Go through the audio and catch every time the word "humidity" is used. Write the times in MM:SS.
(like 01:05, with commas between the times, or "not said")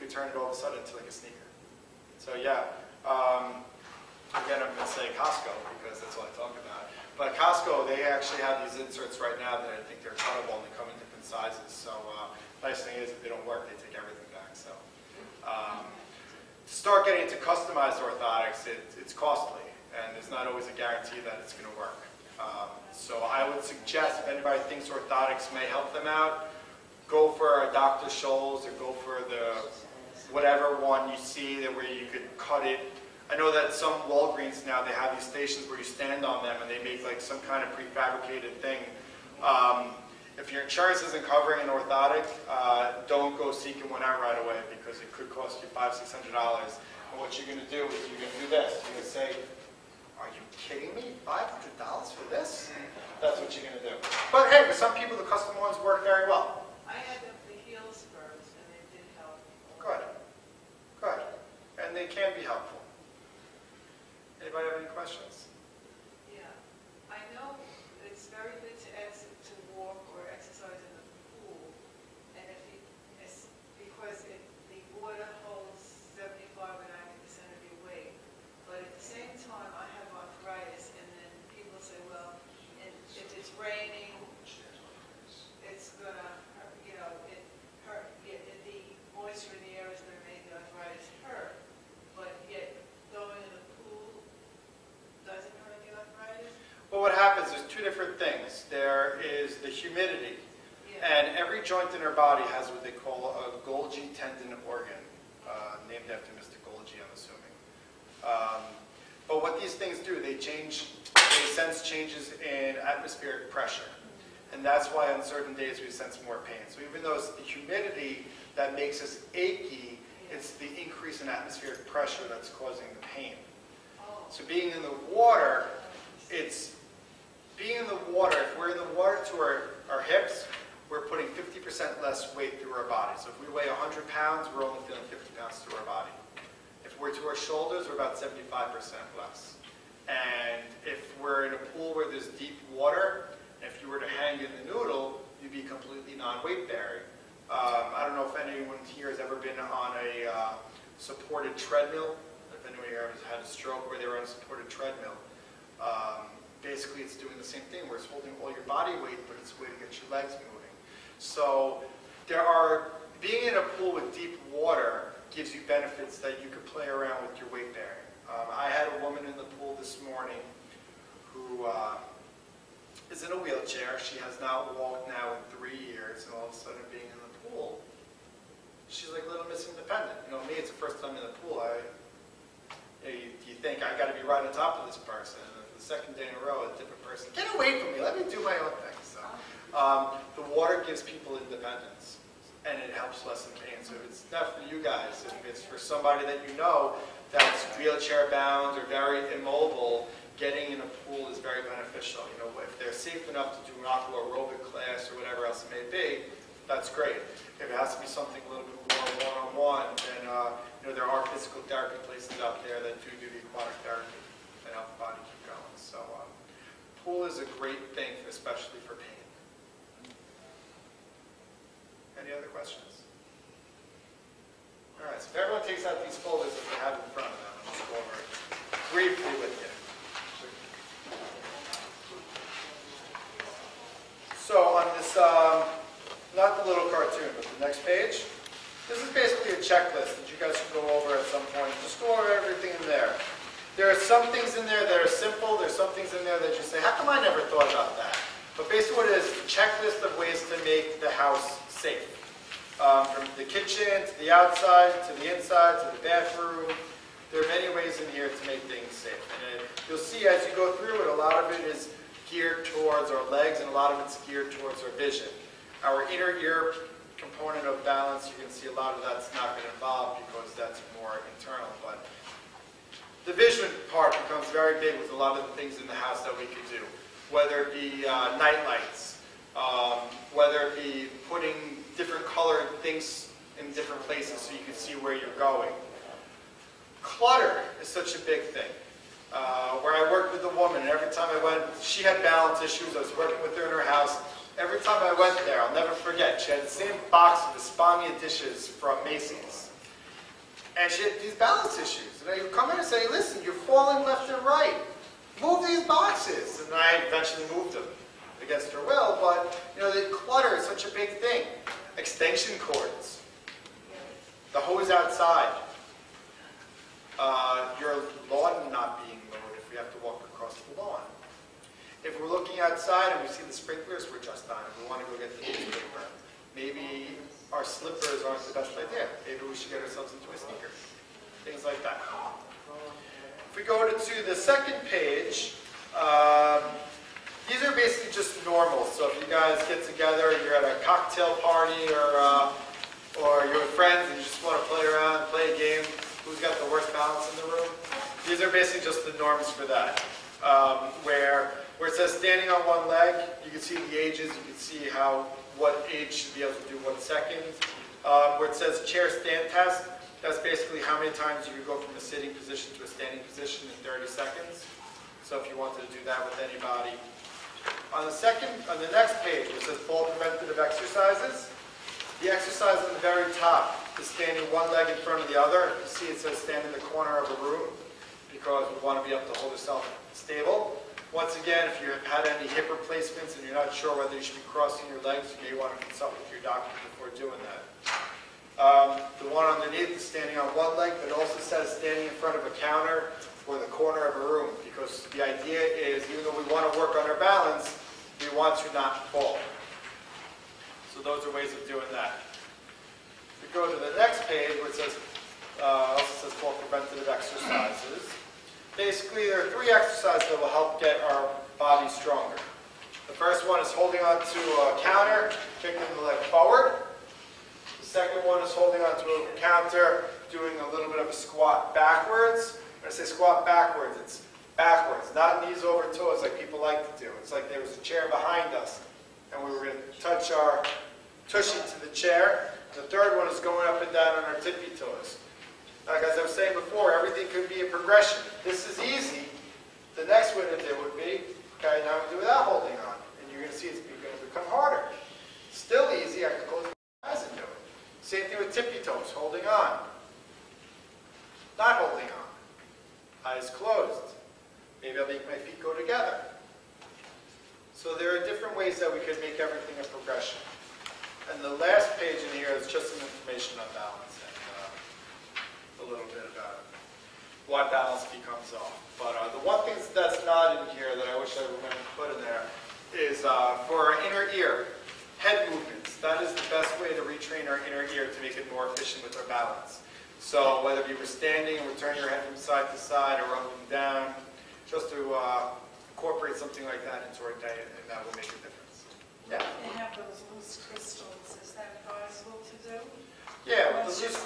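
01:39, 01:57.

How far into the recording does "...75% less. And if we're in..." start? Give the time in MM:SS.
02:18.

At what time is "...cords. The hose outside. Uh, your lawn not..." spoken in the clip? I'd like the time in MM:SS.
05:12.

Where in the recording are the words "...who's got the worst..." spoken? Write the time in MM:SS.
05:46.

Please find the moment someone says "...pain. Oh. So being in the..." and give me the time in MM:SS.
02:03.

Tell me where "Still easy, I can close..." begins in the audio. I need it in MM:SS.
07:25.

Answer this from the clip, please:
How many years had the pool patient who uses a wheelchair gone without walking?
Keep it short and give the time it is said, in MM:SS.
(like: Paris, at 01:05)
3 years, at 02:55.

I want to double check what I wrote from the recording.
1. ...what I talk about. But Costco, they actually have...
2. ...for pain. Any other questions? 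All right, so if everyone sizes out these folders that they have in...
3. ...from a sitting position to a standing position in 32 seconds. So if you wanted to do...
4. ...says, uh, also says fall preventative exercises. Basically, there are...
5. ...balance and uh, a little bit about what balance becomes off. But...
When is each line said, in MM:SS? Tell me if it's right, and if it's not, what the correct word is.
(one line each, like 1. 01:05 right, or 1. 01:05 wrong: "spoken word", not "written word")
1. 00:06 right
2. 03:38 wrong: "takes", not "sizes"
3. 06:01 wrong: "30", not "32"
4. 06:44 right
5. 07:43 right.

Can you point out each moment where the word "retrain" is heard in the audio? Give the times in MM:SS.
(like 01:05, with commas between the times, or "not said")
07:57.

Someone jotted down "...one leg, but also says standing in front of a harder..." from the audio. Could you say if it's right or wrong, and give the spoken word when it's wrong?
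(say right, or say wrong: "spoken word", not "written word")
wrong: "counter", not "harder".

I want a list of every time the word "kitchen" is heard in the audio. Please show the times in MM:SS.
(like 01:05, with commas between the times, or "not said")
04:13.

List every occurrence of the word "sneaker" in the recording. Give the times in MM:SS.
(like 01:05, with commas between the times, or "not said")
00:01, 05:30.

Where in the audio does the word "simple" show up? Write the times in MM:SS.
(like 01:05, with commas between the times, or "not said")
04:05.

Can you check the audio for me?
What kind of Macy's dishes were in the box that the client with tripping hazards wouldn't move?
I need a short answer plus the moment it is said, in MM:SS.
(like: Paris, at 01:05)
Espana dishes, at 04:57.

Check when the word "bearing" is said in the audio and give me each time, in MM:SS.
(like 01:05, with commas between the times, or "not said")
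02:26, 02:47.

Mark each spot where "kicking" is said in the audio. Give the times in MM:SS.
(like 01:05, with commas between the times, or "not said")
06:55.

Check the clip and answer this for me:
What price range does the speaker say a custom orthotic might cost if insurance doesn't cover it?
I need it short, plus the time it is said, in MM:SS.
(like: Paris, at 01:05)
500 to 600 dollars, at 00:45.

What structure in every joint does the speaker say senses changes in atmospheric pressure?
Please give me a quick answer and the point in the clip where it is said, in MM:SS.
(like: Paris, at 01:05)
Golgi tendon organ, at 01:43.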